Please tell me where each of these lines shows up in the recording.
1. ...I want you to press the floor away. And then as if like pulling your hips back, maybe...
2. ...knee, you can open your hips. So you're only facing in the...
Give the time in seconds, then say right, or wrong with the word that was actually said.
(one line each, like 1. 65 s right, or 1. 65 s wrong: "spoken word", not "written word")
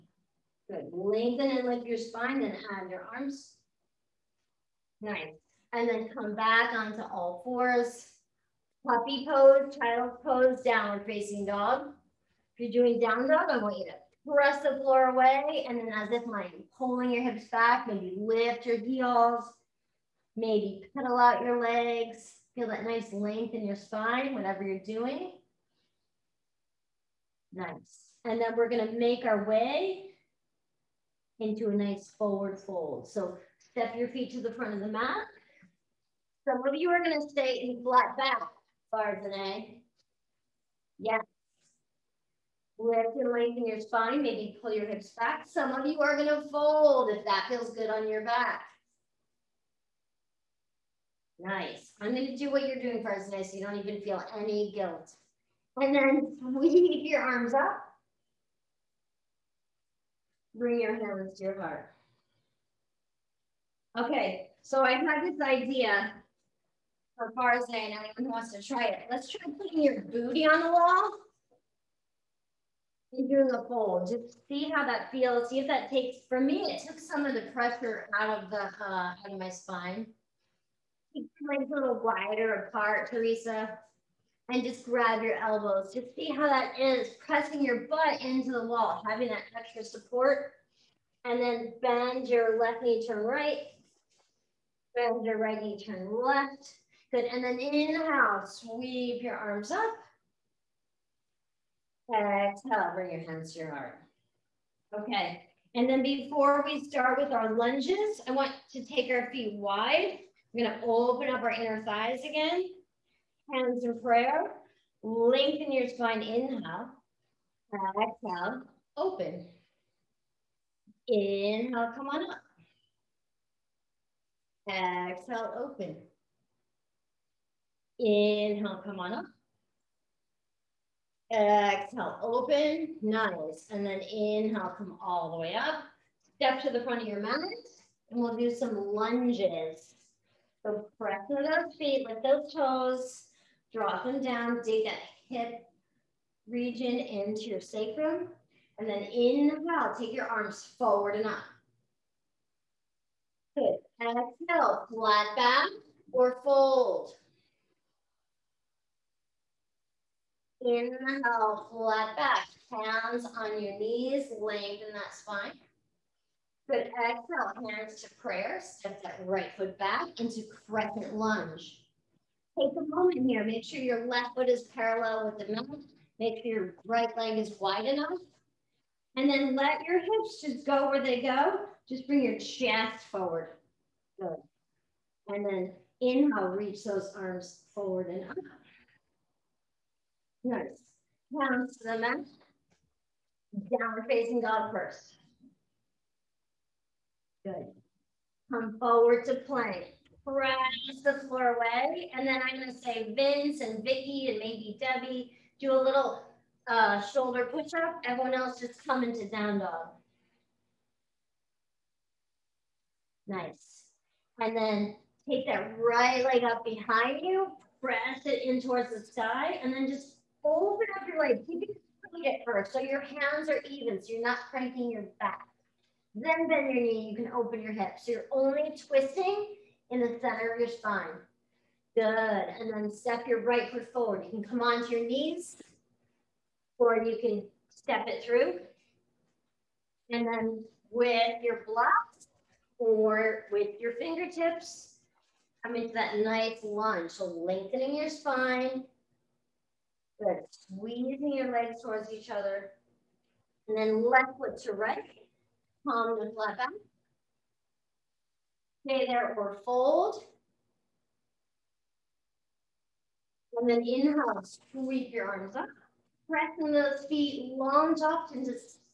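1. 13 s right
2. 226 s wrong: "twisting", not "facing".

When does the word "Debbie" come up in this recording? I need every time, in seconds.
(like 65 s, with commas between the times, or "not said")
204 s.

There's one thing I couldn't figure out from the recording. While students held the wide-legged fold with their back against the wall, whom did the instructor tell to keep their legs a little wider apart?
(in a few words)
Teresa.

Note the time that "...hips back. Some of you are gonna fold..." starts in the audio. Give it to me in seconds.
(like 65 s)
44 s.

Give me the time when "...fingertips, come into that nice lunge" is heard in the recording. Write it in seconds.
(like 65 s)
243 s.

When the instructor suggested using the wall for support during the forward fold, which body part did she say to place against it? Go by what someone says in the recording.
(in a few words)
booty.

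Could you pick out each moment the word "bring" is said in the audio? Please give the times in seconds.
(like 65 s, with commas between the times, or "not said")
60 s, 102 s, 182 s.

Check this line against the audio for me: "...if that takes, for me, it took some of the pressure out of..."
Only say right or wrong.
right.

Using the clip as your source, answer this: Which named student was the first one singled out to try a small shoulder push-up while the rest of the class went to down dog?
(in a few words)
Vince.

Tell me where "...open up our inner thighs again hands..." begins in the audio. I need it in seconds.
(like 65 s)
110 s.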